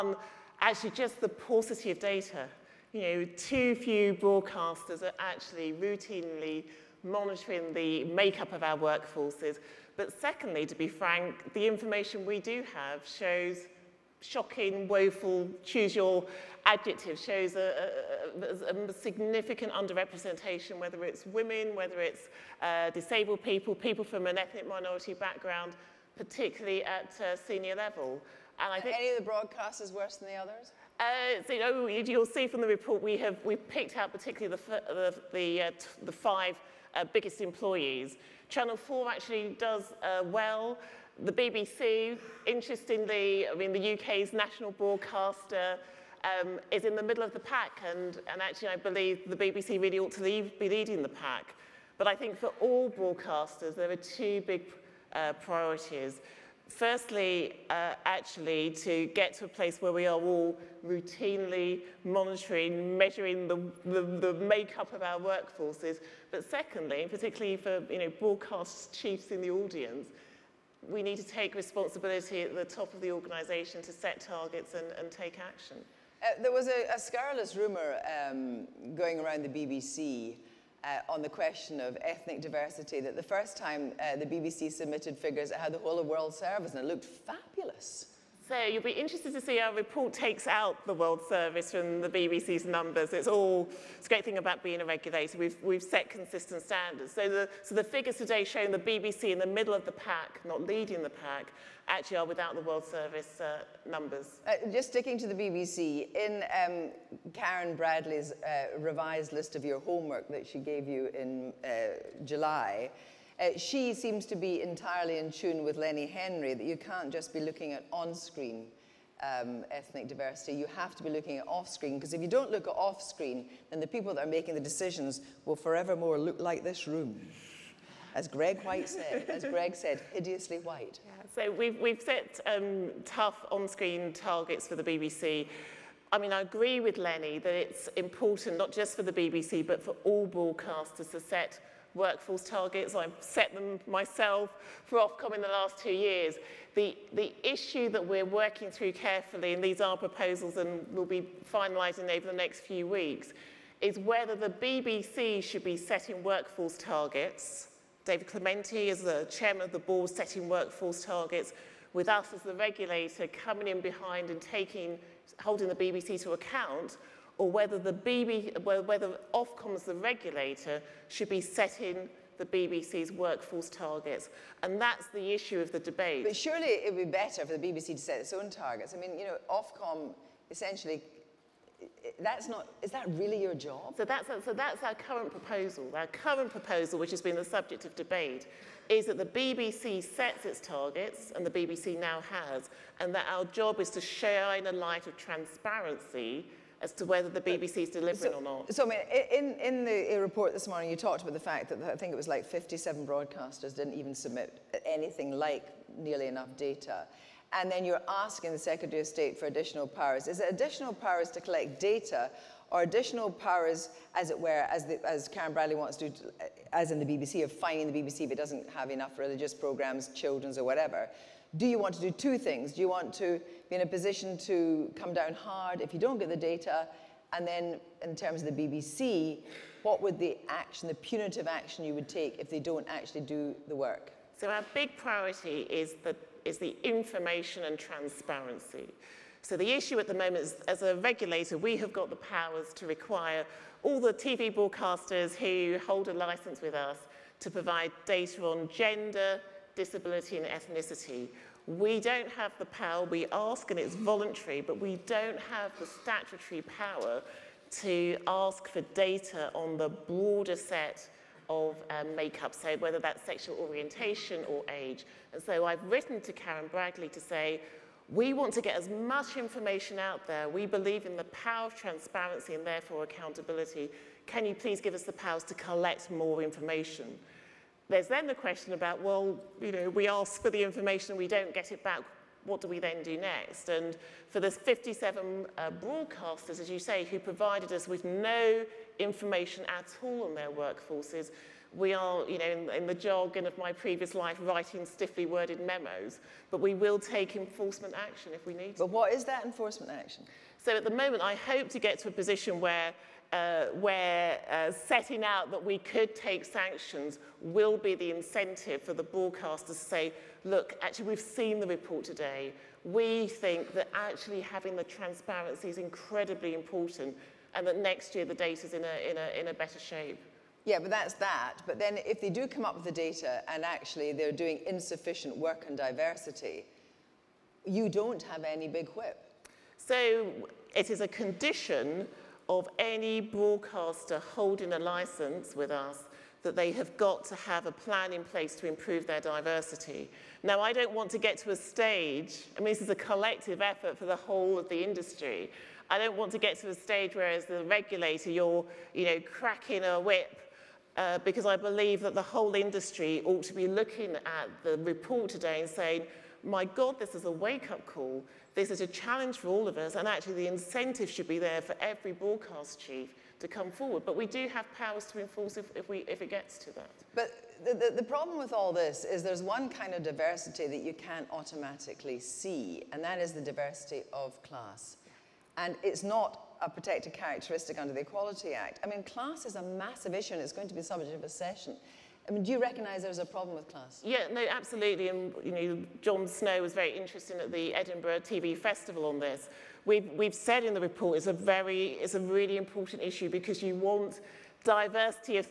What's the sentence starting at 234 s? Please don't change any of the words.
So our big priority is that is the information and transparency.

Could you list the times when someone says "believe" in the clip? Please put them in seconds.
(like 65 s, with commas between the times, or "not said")
48 s, 270 s, 351 s.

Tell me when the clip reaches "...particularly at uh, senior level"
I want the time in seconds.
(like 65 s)
26 s.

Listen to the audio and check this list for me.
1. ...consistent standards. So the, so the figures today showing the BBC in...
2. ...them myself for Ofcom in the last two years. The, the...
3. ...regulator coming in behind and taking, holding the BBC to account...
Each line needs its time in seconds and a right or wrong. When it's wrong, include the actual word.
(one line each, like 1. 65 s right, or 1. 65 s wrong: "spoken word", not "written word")
1. 96 s right
2. 143 s right
3. 162 s right.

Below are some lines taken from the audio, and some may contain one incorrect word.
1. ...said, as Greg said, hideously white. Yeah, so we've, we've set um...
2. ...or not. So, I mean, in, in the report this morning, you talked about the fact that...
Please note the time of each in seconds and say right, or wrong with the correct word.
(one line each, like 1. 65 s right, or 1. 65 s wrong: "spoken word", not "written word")
1. 128 s right
2. 198 s right.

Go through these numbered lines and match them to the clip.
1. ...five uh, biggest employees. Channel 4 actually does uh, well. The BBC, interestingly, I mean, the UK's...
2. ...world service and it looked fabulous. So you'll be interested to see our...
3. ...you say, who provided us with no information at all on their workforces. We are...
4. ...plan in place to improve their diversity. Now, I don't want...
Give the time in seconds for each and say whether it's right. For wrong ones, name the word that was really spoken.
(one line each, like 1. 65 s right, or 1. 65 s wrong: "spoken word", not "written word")
1. 36 s right
2. 86 s right
3. 286 s right
4. 337 s right.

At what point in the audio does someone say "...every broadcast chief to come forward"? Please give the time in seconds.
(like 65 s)
361 s.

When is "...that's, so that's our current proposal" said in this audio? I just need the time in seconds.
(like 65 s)
184 s.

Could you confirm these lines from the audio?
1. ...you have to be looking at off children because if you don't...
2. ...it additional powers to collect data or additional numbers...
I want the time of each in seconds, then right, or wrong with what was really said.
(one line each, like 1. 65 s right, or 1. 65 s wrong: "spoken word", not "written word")
1. 120 s wrong: "screen", not "children"
2. 210 s wrong: "powers", not "numbers".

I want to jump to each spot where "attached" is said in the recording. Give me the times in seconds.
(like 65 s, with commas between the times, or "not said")
not said.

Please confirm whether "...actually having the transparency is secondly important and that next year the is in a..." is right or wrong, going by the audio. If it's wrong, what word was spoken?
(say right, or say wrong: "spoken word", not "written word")
wrong: "incredibly", not "secondly".